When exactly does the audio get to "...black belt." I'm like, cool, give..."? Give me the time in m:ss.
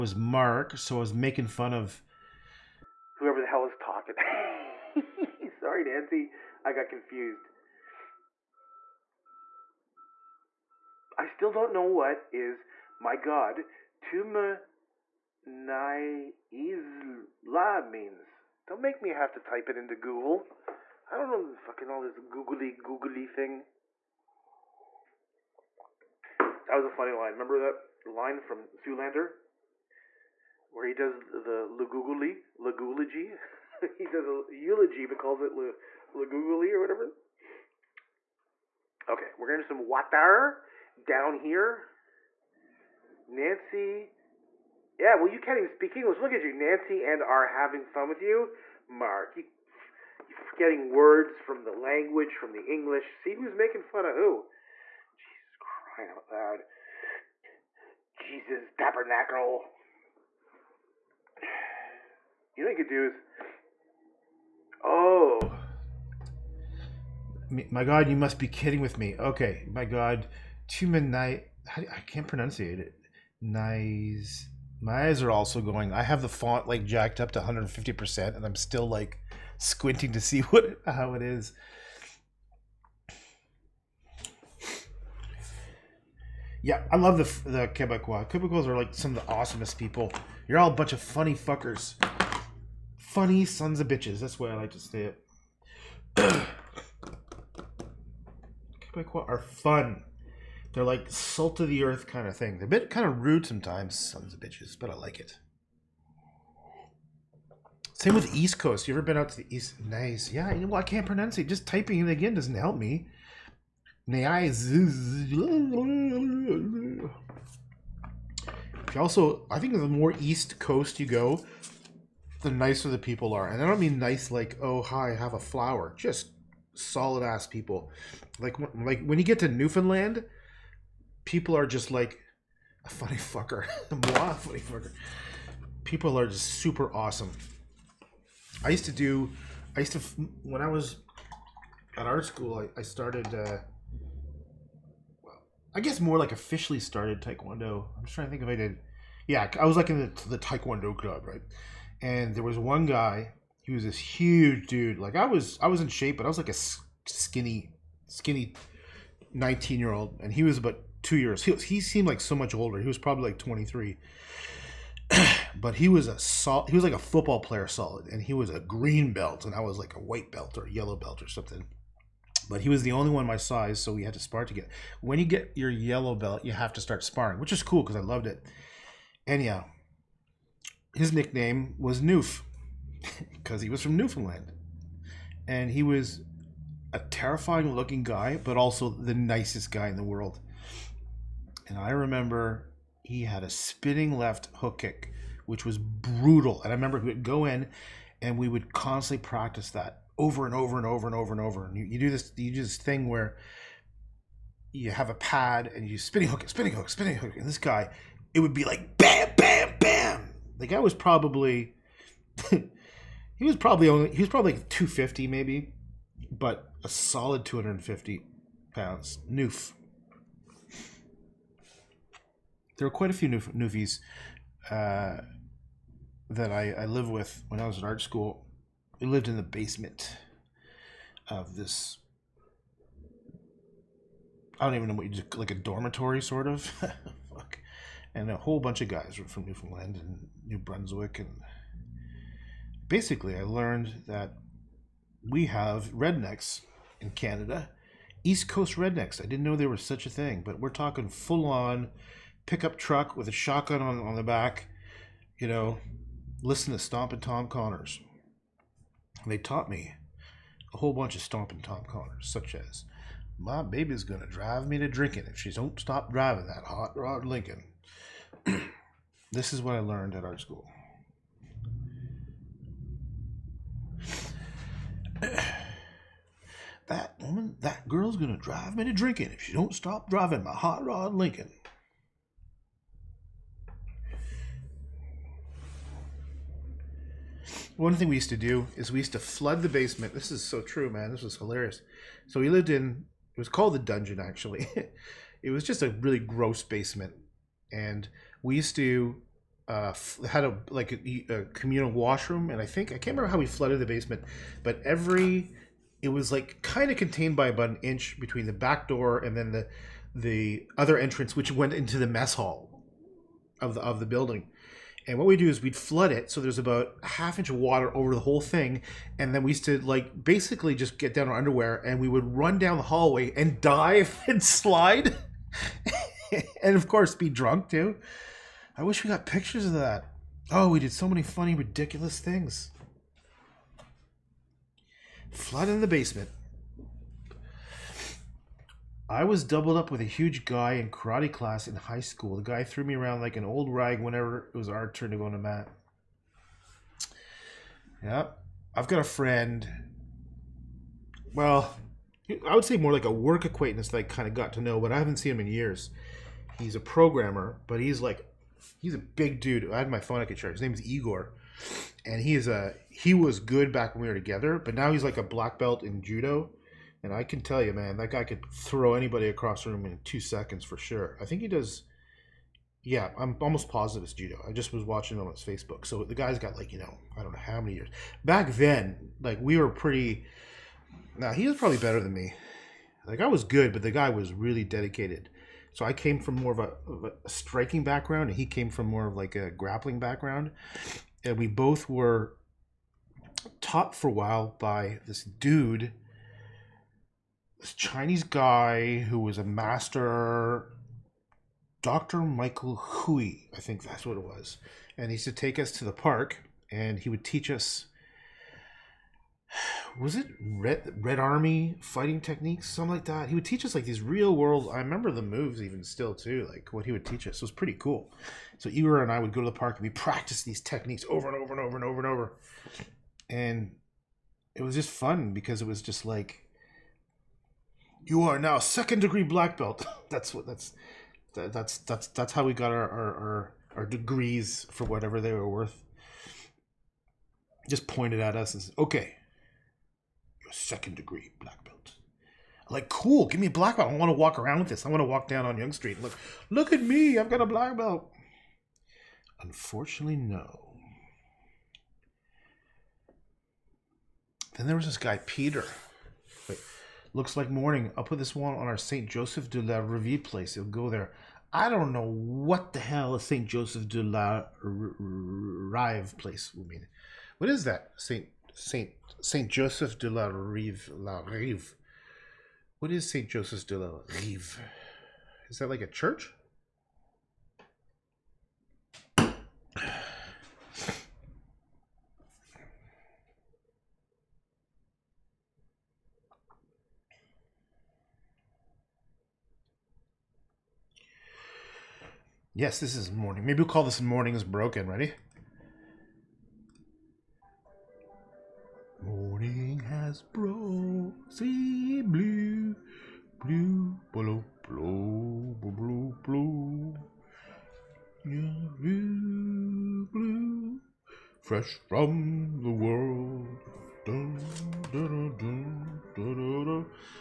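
7:21.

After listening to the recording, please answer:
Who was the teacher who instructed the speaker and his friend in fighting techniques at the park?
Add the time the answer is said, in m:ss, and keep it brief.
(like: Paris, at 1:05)
Dr. Michael Hui, at 6:41.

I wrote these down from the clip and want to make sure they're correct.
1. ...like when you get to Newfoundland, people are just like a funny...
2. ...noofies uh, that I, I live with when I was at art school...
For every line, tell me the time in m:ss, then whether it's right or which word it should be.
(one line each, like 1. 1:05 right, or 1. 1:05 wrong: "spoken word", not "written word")
1. 2:08 right
2. 3:43 right.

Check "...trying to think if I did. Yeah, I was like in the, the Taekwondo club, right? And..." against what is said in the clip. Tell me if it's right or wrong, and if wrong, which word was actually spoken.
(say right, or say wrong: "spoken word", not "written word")
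right.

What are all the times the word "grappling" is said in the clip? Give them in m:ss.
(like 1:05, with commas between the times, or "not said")
6:29.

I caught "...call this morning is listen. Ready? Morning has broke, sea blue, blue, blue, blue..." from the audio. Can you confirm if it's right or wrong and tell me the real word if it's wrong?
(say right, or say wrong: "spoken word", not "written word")
wrong: "broken", not "listen".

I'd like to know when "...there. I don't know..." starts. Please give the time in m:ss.
7:40.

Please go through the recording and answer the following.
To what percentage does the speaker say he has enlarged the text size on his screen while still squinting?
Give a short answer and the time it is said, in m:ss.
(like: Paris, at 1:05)
150%, at 1:17.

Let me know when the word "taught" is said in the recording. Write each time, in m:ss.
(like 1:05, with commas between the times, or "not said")
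4:19, 6:33.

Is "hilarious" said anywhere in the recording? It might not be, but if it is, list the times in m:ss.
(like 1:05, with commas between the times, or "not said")
4:51.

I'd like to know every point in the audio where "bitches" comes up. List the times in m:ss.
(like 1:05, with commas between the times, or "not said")
1:33, 1:44.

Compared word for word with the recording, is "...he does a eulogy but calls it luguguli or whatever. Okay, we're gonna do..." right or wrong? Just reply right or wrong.
right.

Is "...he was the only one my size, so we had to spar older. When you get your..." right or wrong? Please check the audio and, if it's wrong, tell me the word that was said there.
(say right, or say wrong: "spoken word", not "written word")
wrong: "together", not "older".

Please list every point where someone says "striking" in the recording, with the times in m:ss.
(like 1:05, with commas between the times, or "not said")
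6:27.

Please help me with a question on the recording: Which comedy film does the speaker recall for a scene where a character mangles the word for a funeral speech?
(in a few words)
Zoolander.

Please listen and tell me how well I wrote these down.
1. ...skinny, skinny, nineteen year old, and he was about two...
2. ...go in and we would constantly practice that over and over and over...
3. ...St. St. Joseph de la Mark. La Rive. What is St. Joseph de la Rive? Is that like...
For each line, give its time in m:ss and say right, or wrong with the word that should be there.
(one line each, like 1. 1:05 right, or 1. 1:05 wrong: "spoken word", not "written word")
1. 2:37 right
2. 3:17 right
3. 7:48 wrong: "Rive", not "Mark".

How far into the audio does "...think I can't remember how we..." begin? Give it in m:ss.
5:02.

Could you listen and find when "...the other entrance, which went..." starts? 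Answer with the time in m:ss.
5:10.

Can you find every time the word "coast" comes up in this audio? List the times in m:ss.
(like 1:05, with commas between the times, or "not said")
1:48, 2:00, 4:08.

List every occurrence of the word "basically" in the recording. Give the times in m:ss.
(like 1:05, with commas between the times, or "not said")
4:02, 5:20.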